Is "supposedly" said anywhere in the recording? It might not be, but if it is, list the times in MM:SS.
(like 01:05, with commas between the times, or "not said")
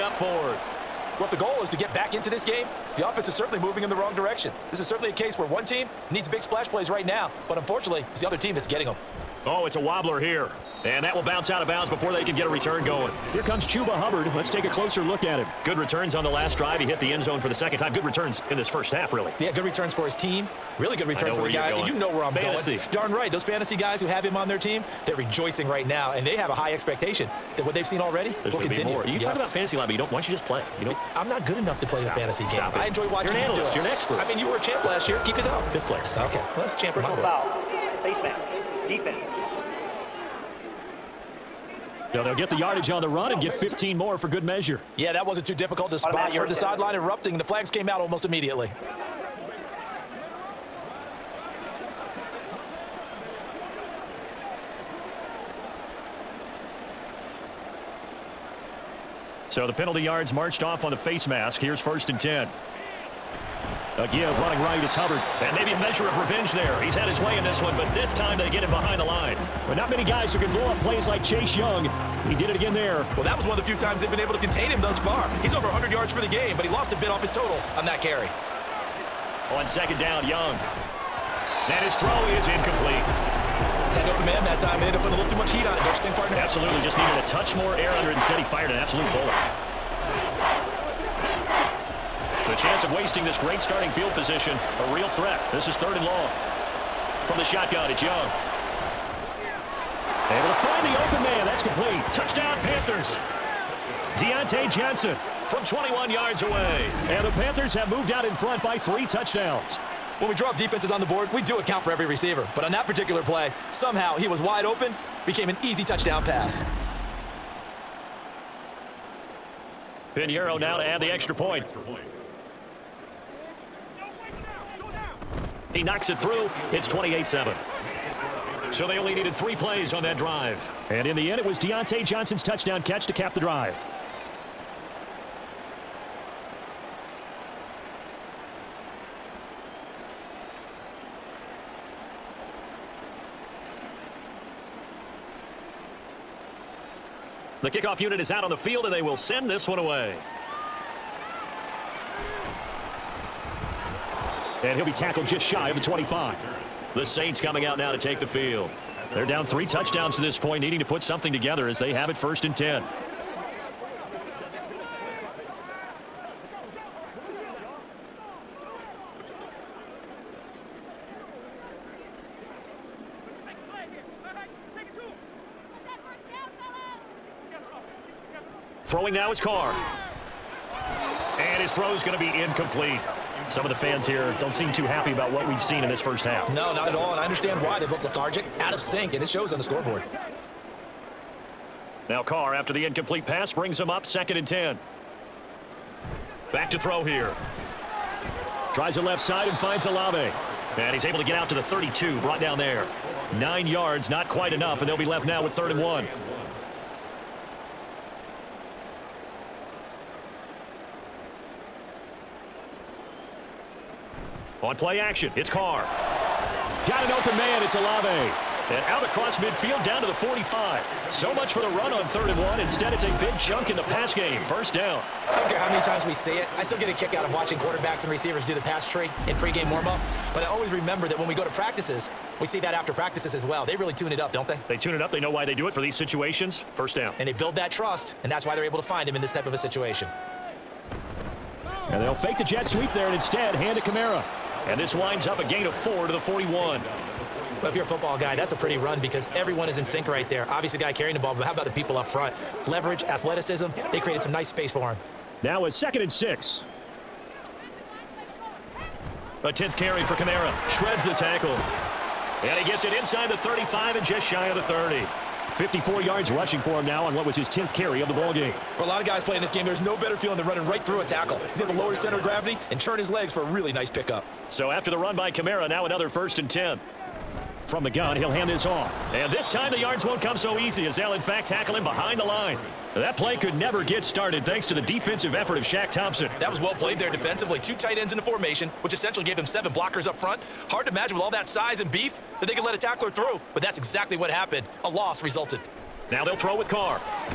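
not said.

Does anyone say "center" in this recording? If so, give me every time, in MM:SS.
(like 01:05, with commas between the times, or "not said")
04:31.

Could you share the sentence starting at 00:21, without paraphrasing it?
And you know where I'm fantasy.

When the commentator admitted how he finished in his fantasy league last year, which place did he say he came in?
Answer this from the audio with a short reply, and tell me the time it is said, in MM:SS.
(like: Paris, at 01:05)
5th place, at 00:35.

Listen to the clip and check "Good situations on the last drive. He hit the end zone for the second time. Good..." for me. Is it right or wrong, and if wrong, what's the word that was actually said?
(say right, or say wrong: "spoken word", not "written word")
wrong: "returns", not "situations".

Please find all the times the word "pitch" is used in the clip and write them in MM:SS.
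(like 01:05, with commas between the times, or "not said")
not said.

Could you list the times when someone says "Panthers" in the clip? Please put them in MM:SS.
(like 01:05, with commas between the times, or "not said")
01:42, 01:47.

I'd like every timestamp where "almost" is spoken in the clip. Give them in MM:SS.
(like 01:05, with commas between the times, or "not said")
00:48.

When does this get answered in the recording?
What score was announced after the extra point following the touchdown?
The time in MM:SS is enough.
02:06.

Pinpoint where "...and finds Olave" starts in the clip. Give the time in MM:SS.
03:19.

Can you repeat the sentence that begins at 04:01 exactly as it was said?
And they'll fake the jet sweep there and instead hand to Kamara.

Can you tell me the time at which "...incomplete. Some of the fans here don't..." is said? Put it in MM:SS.
03:02.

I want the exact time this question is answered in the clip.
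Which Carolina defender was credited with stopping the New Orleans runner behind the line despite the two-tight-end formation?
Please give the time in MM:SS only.
04:45.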